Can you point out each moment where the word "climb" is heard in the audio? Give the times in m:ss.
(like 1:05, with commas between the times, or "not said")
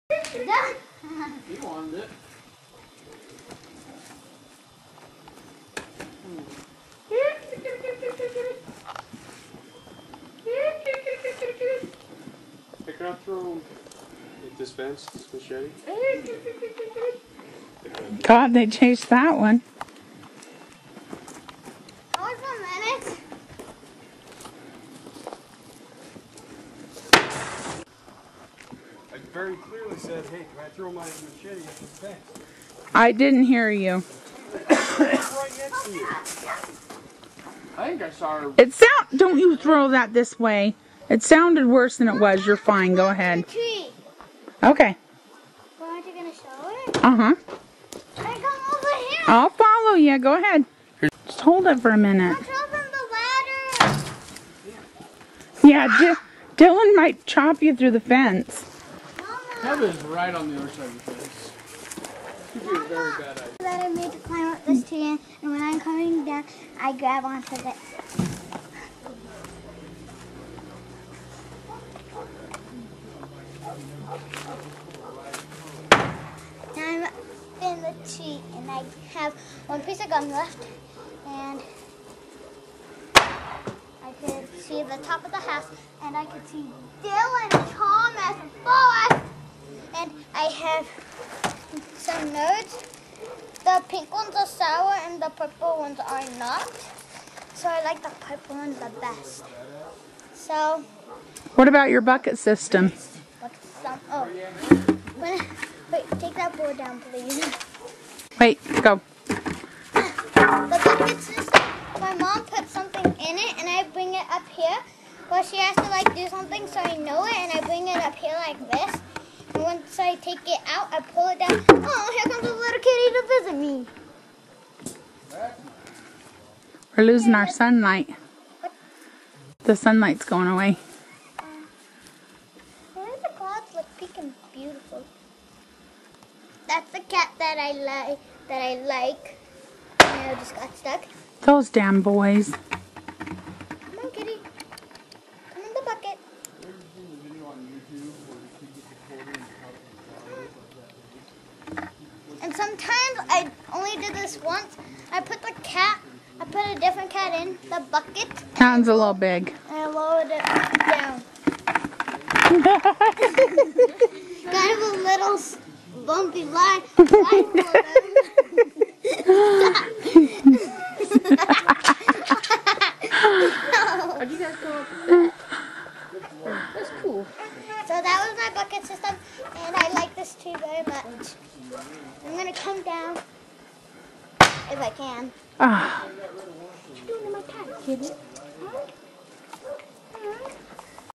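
1:04.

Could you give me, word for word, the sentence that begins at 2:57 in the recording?
So that was my bucket system thank you very much.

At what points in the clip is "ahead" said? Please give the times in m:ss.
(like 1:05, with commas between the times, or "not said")
0:43, 0:50.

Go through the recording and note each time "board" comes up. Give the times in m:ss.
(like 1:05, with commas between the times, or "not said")
1:46.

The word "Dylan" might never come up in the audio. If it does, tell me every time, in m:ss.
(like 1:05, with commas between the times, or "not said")
0:56, 1:27.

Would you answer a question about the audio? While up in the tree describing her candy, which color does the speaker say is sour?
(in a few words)
pink.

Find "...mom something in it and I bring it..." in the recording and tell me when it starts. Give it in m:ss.
1:52.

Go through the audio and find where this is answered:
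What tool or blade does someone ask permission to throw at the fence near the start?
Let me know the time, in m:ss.
0:31.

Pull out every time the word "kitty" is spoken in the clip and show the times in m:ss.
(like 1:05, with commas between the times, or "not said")
2:02, 3:07.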